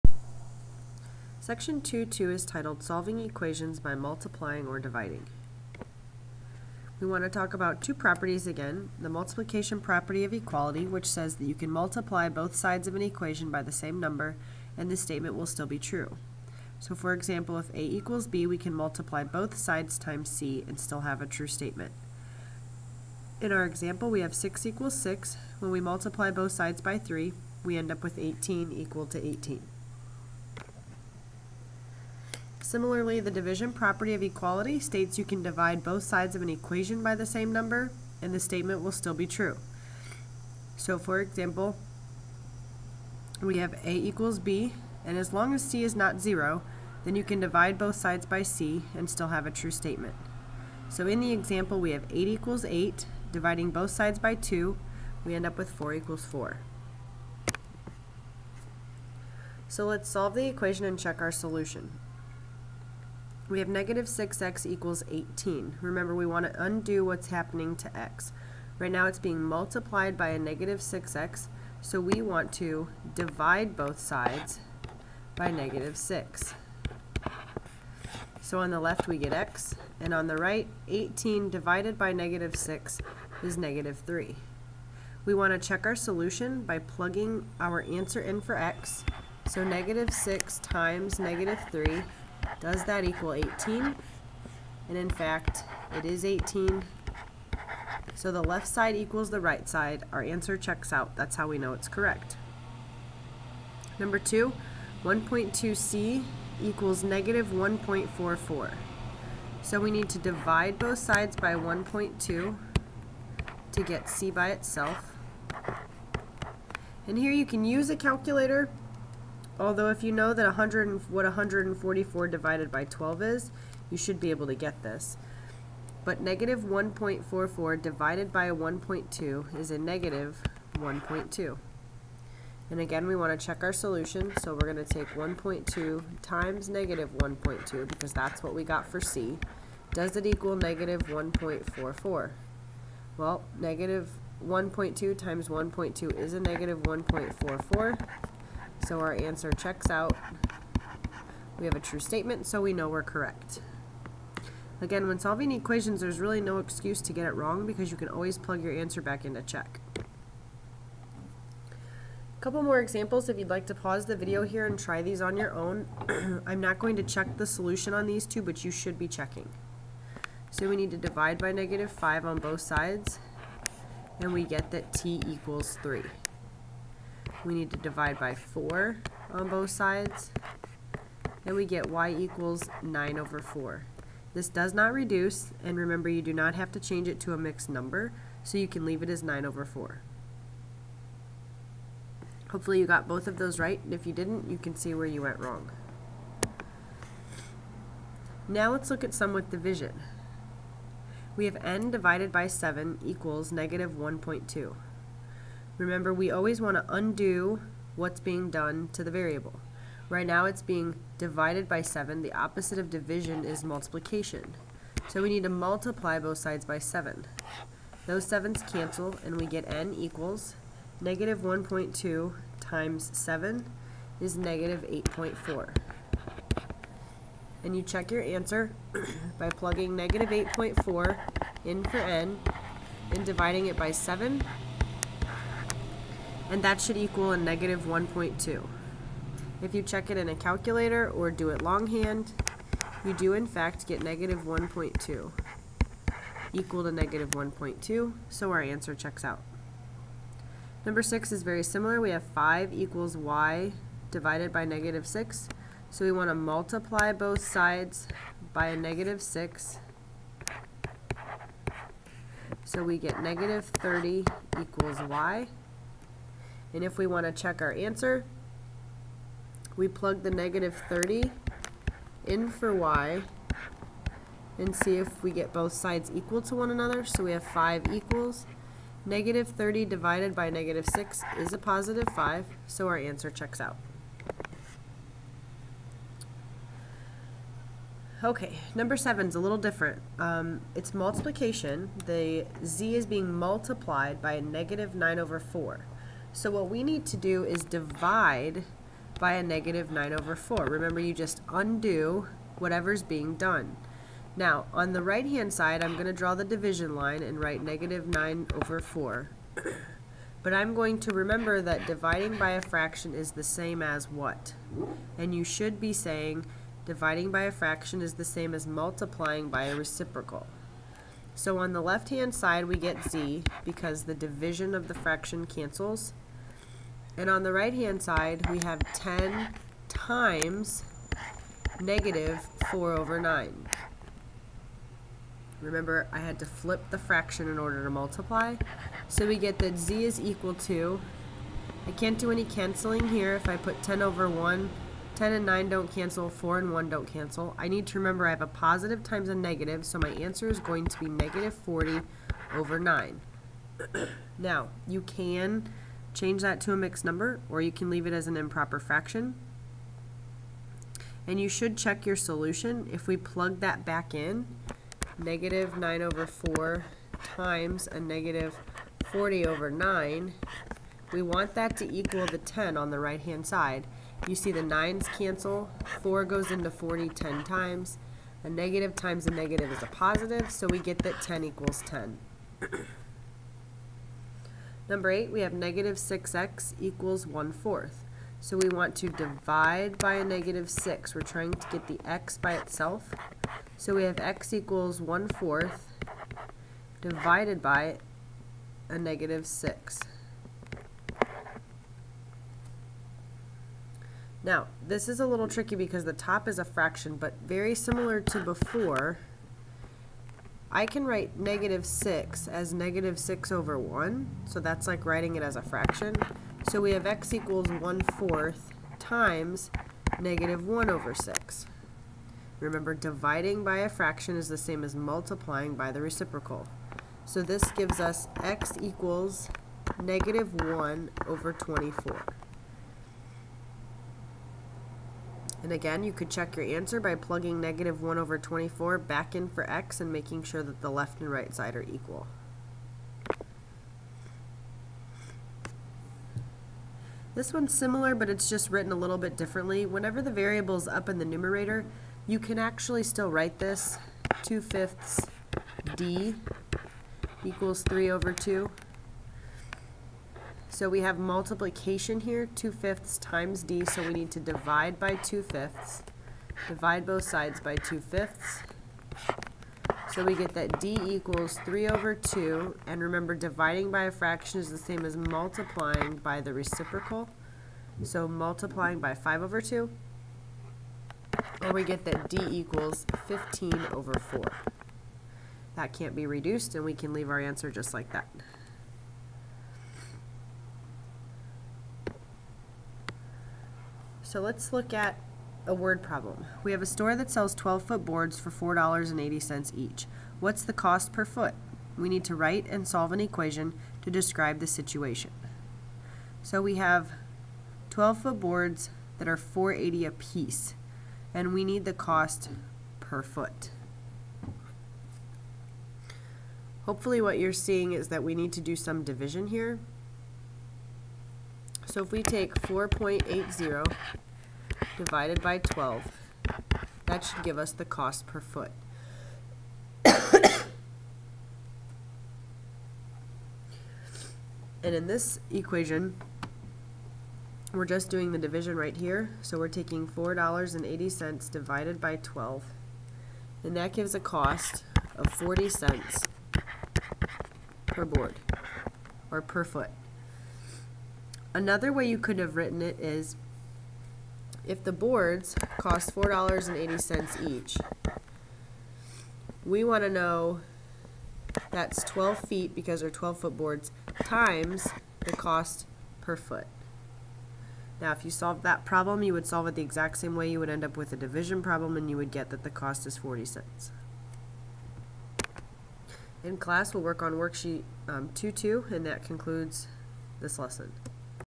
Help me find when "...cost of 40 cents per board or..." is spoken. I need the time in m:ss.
9:04.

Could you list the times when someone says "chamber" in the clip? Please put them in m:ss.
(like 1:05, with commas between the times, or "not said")
not said.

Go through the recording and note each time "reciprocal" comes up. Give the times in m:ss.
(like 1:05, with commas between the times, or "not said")
5:19, 7:06, 7:56.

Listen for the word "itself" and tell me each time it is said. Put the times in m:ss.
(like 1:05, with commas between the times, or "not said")
1:54, 6:32.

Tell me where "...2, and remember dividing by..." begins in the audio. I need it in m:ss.
7:52.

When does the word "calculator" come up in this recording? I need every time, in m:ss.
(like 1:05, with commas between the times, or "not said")
1:57, 4:00.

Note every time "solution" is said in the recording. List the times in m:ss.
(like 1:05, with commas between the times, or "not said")
1:01, 1:25, 2:13, 2:47, 6:02.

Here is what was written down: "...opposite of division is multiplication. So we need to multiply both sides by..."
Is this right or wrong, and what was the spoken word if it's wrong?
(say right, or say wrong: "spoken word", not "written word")
right.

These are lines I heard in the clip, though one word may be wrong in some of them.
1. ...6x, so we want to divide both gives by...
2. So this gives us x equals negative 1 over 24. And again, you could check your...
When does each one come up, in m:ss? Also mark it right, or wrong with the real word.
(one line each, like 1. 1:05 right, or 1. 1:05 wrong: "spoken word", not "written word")
1. 1:10 wrong: "sides", not "gives"
2. 7:07 right.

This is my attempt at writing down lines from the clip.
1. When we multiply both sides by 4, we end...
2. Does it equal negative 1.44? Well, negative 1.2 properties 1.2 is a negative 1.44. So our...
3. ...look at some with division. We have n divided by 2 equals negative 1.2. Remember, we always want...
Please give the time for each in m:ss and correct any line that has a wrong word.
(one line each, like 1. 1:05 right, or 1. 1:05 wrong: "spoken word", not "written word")
1. 0:25 wrong: "3", not "4"
2. 2:19 wrong: "times", not "properties"
3. 3:18 wrong: "7", not "2".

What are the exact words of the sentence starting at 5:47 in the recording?
I need to remember I have a positive times a negative, so my answer is going to be negative 40 over 9.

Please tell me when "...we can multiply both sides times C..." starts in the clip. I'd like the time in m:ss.
0:18.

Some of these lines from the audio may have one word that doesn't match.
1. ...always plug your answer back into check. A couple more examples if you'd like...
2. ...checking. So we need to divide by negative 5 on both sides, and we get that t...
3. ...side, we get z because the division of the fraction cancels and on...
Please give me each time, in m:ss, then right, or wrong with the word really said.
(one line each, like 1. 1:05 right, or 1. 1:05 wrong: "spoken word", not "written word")
1. 2:38 right
2. 2:49 right
3. 5:22 right.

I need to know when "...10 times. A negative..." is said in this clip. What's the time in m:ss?
6:17.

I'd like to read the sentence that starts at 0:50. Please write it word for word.
So in the example, we have 8 equals 8, dividing both sides by 2, we end up with 4 equals 4.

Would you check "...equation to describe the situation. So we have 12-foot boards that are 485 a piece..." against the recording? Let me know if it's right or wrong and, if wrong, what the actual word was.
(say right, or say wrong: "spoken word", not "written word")
wrong: "480", not "485".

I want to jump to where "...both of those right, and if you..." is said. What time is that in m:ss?
3:13.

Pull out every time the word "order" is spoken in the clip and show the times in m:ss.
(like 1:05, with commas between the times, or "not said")
5:37.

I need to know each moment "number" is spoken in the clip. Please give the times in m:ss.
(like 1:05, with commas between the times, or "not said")
0:13, 0:37, 1:43, 3:07, 4:10, 4:48, 5:57, 6:24.